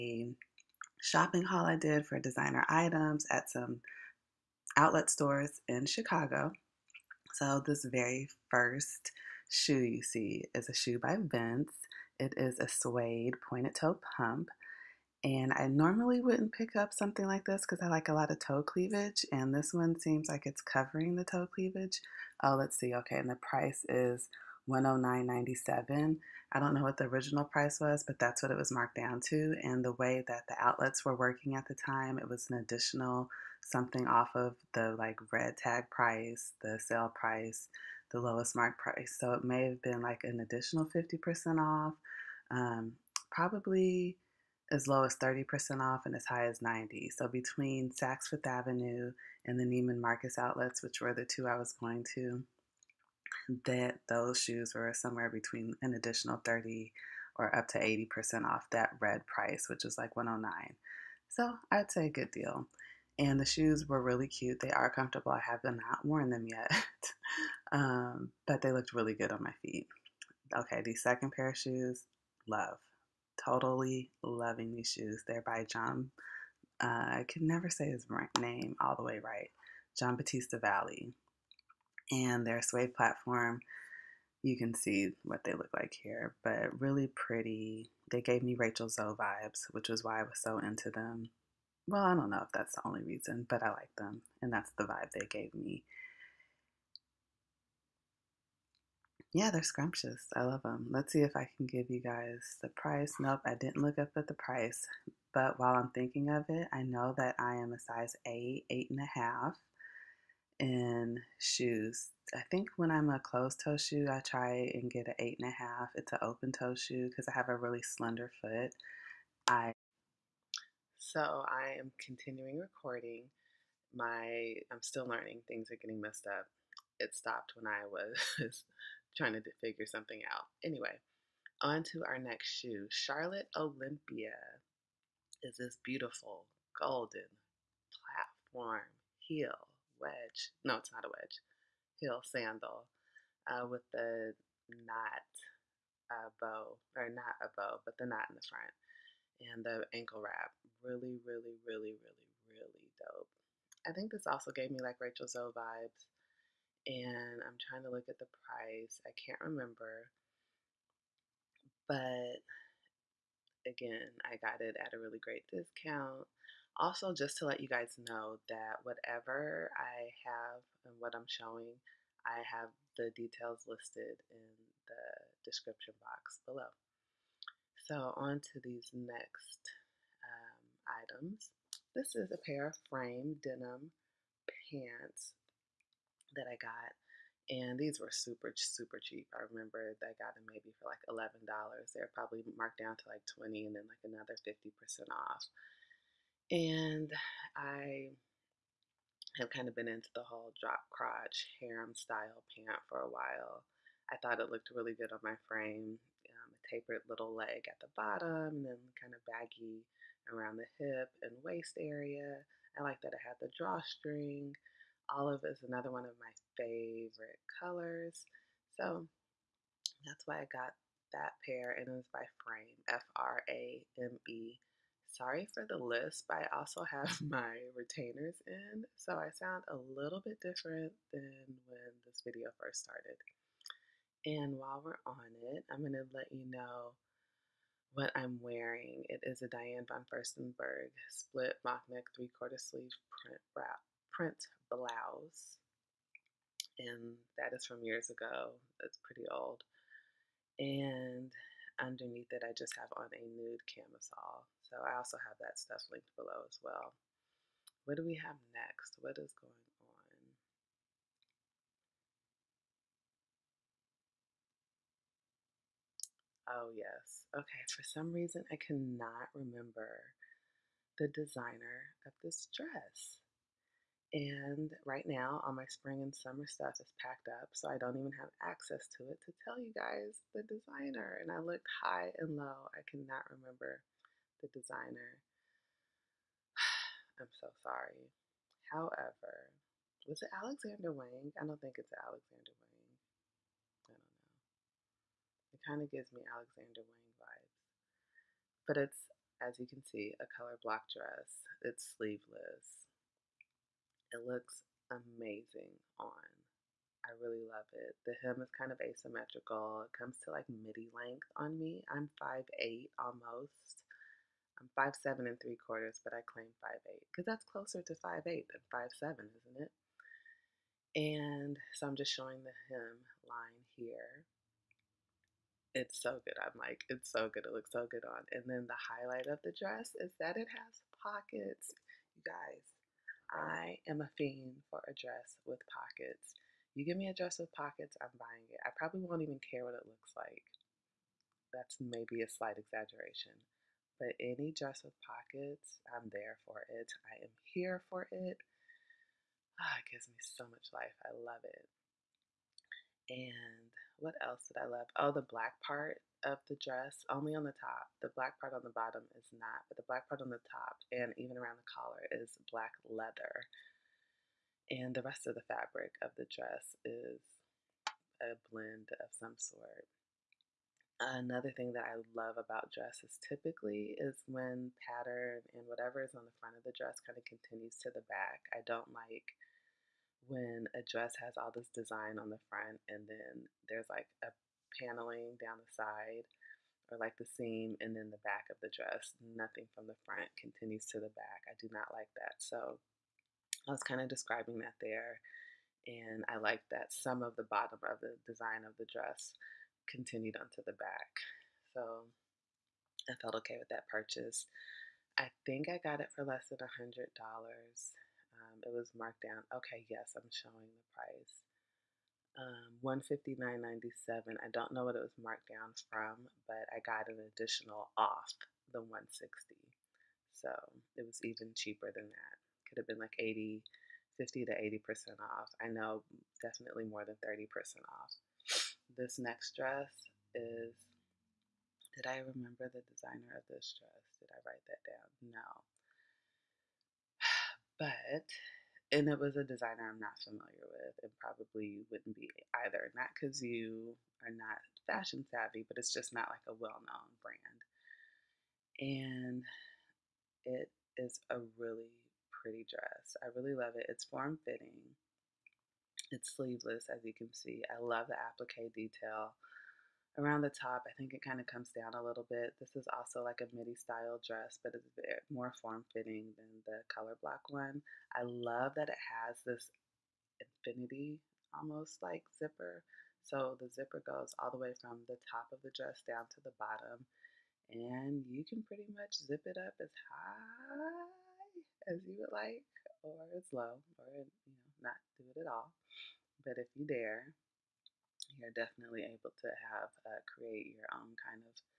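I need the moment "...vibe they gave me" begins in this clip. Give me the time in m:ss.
1:34.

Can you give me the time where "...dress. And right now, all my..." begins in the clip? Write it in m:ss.
4:32.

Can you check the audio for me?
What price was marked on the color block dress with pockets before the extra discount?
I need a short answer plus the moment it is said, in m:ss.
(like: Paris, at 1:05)
$159.97, at 6:52.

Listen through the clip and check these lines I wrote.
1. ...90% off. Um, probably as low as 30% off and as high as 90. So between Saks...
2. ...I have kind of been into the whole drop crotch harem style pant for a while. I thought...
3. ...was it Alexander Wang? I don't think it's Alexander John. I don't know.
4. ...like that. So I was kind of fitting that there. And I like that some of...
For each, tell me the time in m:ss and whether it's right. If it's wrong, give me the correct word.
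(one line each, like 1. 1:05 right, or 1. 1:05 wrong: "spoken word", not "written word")
1. 0:40 wrong: "50", not "90"
2. 3:17 right
3. 4:50 wrong: "Wang", not "John"
4. 6:31 wrong: "describing", not "fitting".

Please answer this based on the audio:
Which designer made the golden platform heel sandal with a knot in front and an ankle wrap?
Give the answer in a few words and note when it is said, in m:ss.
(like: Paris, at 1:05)
Charlotte Olympia, at 2:12.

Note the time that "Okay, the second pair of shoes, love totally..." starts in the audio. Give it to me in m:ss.
1:10.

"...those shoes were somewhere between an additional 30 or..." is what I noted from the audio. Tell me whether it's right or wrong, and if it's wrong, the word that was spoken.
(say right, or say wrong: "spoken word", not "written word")
right.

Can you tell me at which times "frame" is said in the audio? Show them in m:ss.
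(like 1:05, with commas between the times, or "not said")
3:02, 3:25, 3:42.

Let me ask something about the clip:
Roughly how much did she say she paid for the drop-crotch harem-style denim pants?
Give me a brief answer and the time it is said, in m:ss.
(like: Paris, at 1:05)
$11, at 3:11.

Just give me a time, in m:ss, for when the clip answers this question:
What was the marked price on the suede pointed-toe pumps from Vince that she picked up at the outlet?
0:24.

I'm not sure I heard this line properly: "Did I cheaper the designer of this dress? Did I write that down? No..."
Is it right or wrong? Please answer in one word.
wrong.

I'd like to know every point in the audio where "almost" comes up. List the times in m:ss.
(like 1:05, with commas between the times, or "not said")
5:12, 7:51.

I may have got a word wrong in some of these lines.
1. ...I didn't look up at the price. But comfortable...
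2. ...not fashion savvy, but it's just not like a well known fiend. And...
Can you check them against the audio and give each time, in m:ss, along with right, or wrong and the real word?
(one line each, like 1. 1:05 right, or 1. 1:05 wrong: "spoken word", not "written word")
1. 1:43 wrong: "while", not "comfortable"
2. 7:24 wrong: "brand", not "fiend".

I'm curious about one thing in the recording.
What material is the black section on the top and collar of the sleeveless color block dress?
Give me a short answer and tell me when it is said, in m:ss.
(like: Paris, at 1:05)
Black leather, at 6:02.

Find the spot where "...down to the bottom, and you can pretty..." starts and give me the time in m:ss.
7:56.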